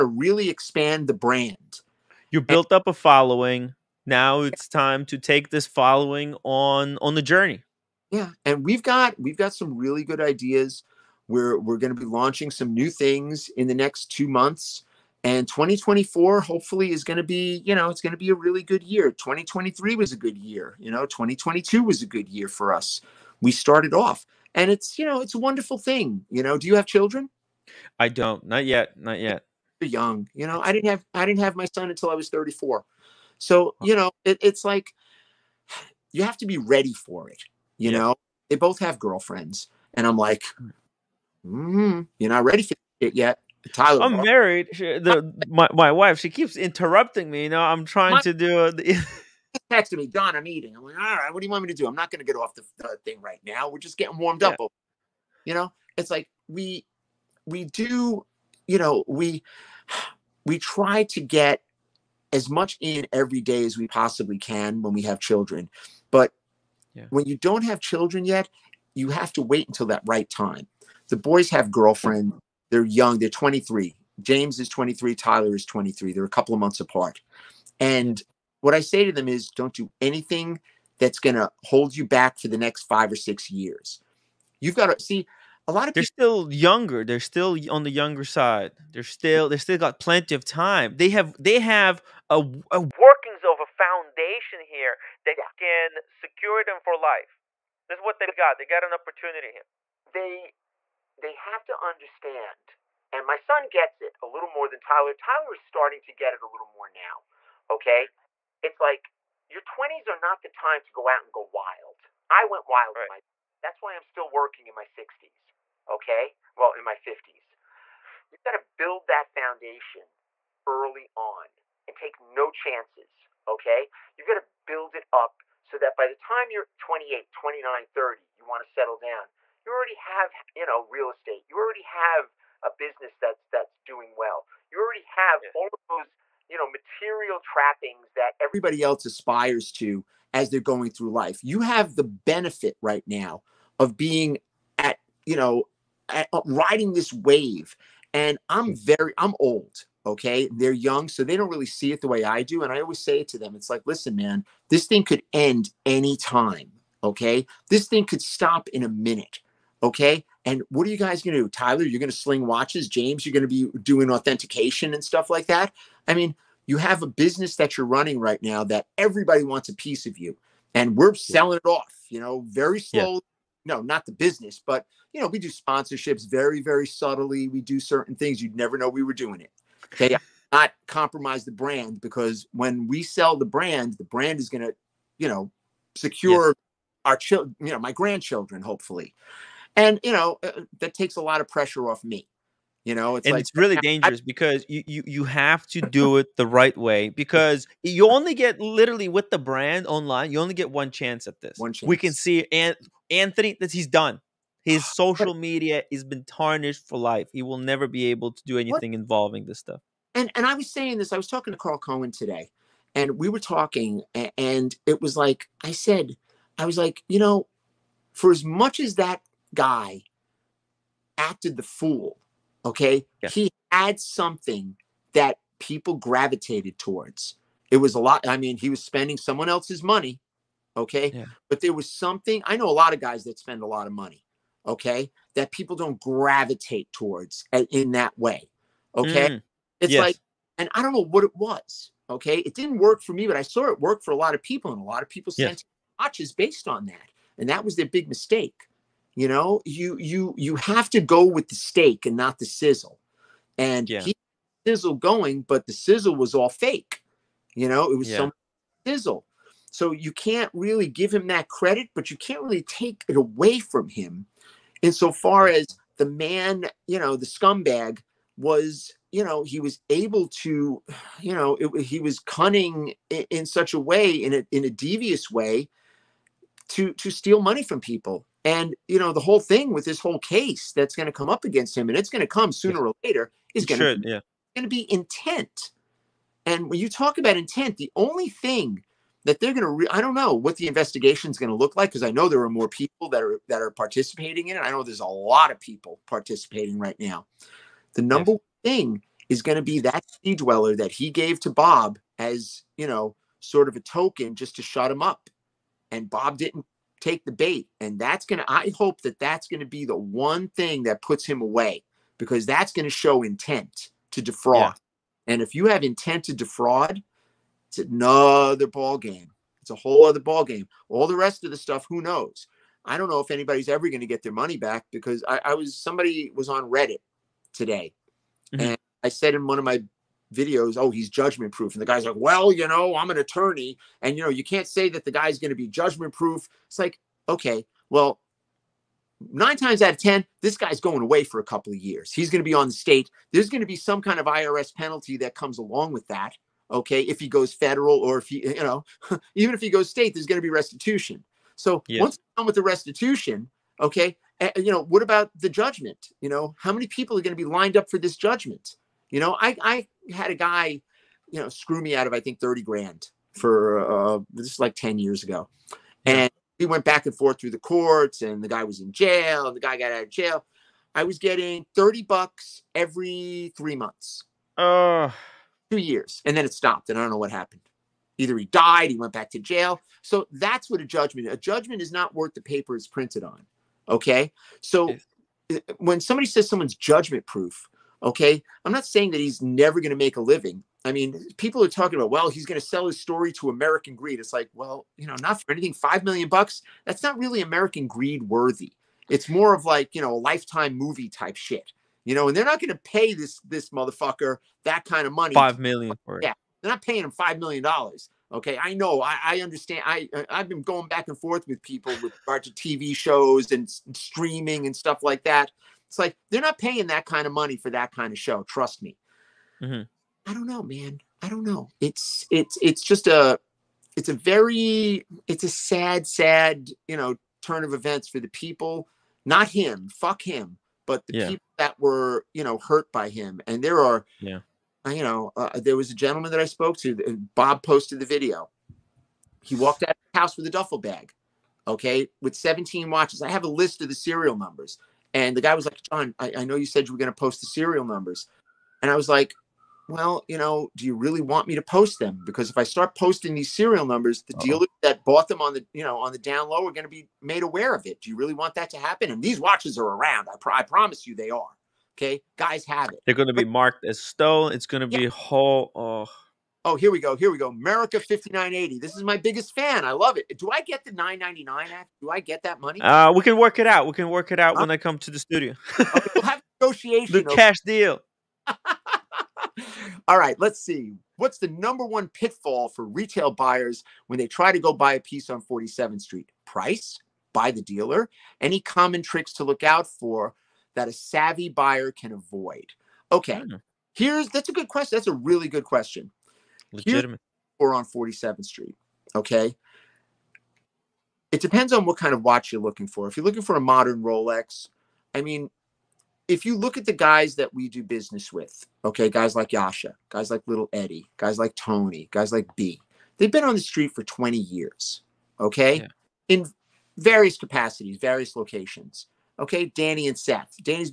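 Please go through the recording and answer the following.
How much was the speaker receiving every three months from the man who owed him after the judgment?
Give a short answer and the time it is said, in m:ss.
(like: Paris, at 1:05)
30 bucks, at 6:11.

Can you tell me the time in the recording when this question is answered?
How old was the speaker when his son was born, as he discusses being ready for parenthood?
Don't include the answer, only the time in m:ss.
0:32.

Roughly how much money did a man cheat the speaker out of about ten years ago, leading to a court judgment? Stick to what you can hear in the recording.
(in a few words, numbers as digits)
30 grand.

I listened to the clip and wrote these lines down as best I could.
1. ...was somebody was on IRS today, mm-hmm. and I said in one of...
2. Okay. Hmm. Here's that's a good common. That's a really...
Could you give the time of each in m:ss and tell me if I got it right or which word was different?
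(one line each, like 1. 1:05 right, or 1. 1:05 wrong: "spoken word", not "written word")
1. 5:25 wrong: "Reddit", not "IRS"
2. 8:13 wrong: "question", not "common".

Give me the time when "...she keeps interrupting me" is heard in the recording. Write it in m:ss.
0:46.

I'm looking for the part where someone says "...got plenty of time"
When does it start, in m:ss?
1:29.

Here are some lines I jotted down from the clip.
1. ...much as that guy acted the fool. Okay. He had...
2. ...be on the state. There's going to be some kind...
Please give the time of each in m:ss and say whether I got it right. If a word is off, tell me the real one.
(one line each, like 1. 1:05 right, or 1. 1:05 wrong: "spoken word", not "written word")
1. 3:38 right
2. 5:42 right.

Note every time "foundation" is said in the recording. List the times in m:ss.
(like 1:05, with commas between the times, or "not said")
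1:33, 1:59.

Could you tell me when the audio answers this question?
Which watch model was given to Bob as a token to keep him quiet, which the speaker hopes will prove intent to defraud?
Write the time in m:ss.
5:00.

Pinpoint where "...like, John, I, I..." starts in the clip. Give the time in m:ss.
7:25.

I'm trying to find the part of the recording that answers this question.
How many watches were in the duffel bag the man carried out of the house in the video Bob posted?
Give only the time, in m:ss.
7:22.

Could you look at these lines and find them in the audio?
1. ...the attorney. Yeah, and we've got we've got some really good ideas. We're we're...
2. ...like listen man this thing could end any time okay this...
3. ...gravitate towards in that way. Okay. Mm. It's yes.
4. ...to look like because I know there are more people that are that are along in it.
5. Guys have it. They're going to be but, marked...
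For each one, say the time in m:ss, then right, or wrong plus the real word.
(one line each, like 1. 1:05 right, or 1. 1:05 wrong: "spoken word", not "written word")
1. 0:07 wrong: "journey", not "attorney"
2. 2:33 right
3. 3:55 right
4. 4:51 wrong: "participating", not "along"
5. 7:42 right.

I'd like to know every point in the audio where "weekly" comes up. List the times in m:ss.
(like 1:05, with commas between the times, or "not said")
not said.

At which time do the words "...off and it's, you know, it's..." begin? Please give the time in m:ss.
0:23.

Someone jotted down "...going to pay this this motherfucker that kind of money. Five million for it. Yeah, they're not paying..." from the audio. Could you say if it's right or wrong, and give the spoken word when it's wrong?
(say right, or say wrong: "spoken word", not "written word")
right.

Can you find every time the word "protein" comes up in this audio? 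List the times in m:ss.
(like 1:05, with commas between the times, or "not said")
not said.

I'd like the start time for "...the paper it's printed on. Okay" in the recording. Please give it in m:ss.
6:22.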